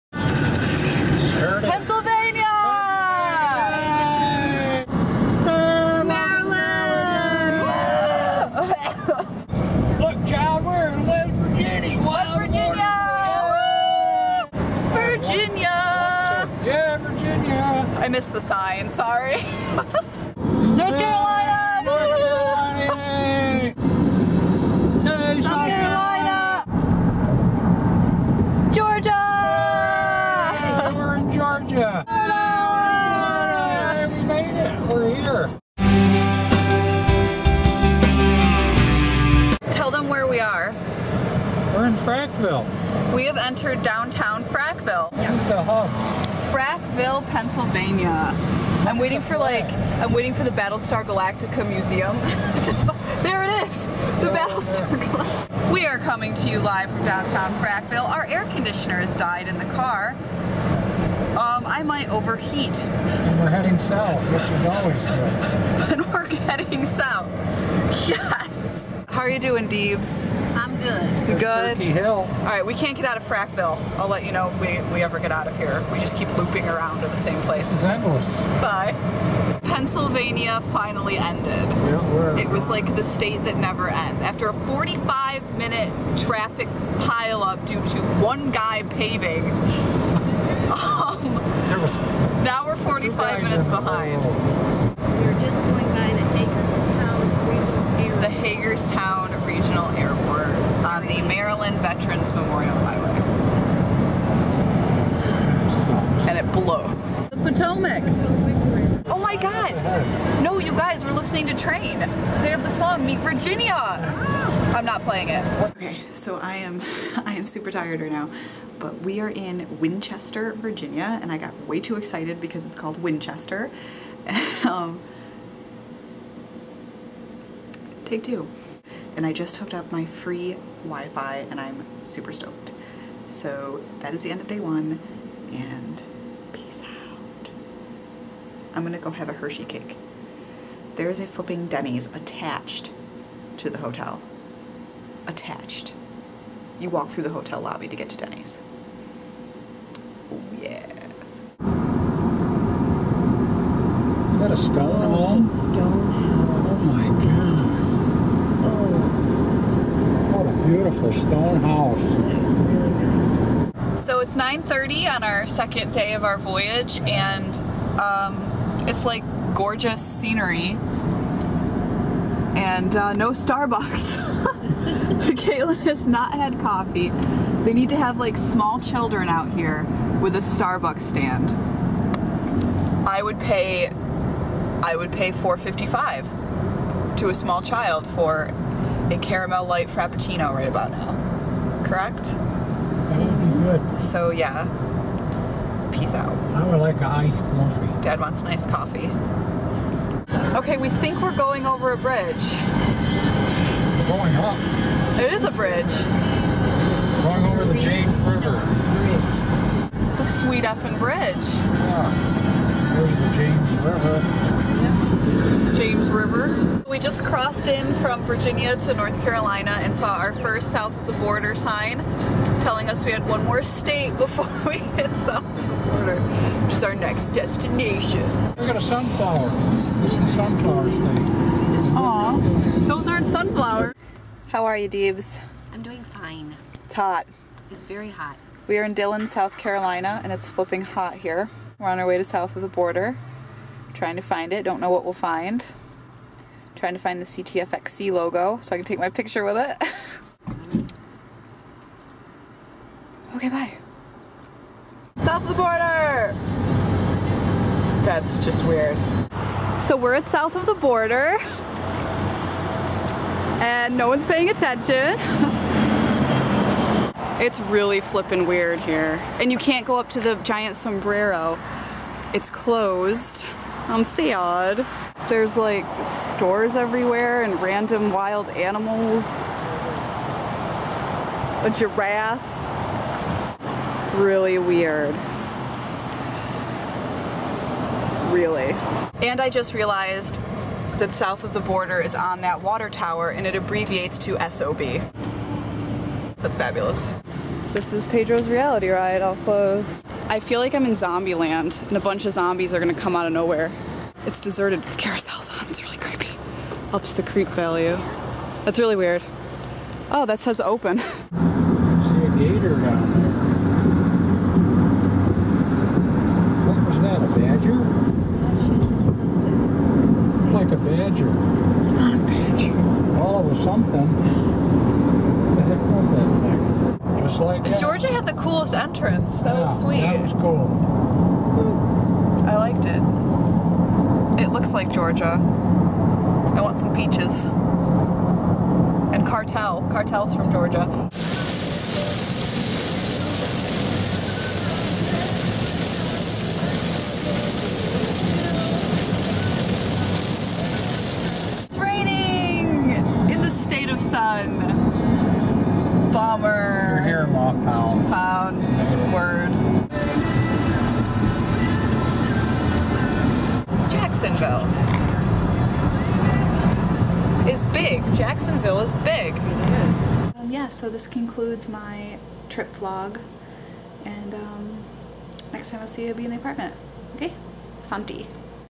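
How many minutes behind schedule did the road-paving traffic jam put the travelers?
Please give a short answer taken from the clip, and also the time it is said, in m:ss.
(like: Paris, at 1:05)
45, at 1:32.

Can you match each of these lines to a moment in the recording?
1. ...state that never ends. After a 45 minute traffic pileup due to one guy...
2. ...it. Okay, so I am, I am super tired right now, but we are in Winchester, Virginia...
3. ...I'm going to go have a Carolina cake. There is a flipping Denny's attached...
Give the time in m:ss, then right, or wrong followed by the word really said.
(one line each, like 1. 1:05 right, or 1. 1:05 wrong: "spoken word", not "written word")
1. 1:23 right
2. 1:55 right
3. 2:18 wrong: "Hershey", not "Carolina".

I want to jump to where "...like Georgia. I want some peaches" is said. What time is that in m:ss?
5:34.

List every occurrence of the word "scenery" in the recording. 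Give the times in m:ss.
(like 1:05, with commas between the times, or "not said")
2:50.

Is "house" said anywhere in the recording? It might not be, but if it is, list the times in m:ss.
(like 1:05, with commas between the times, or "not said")
2:36, 2:41.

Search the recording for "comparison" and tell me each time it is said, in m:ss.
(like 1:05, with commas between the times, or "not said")
not said.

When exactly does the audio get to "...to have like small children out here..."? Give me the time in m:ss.
2:57.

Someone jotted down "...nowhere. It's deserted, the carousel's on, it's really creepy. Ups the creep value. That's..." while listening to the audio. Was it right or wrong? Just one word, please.
right.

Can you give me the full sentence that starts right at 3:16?
I would like an iced coffee.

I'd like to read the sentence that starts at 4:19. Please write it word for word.
So we're at south of the border and no one's paying attention.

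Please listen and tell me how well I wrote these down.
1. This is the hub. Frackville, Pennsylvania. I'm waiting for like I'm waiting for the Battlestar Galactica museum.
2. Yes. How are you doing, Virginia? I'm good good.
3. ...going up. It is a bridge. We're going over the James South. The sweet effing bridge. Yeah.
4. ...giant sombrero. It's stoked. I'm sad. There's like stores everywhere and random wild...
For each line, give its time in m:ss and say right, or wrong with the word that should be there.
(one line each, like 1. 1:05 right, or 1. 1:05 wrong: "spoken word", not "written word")
1. 0:45 right
2. 1:08 wrong: "Deebs", not "Virginia"
3. 3:24 wrong: "River", not "South"
4. 4:30 wrong: "closed", not "stoked".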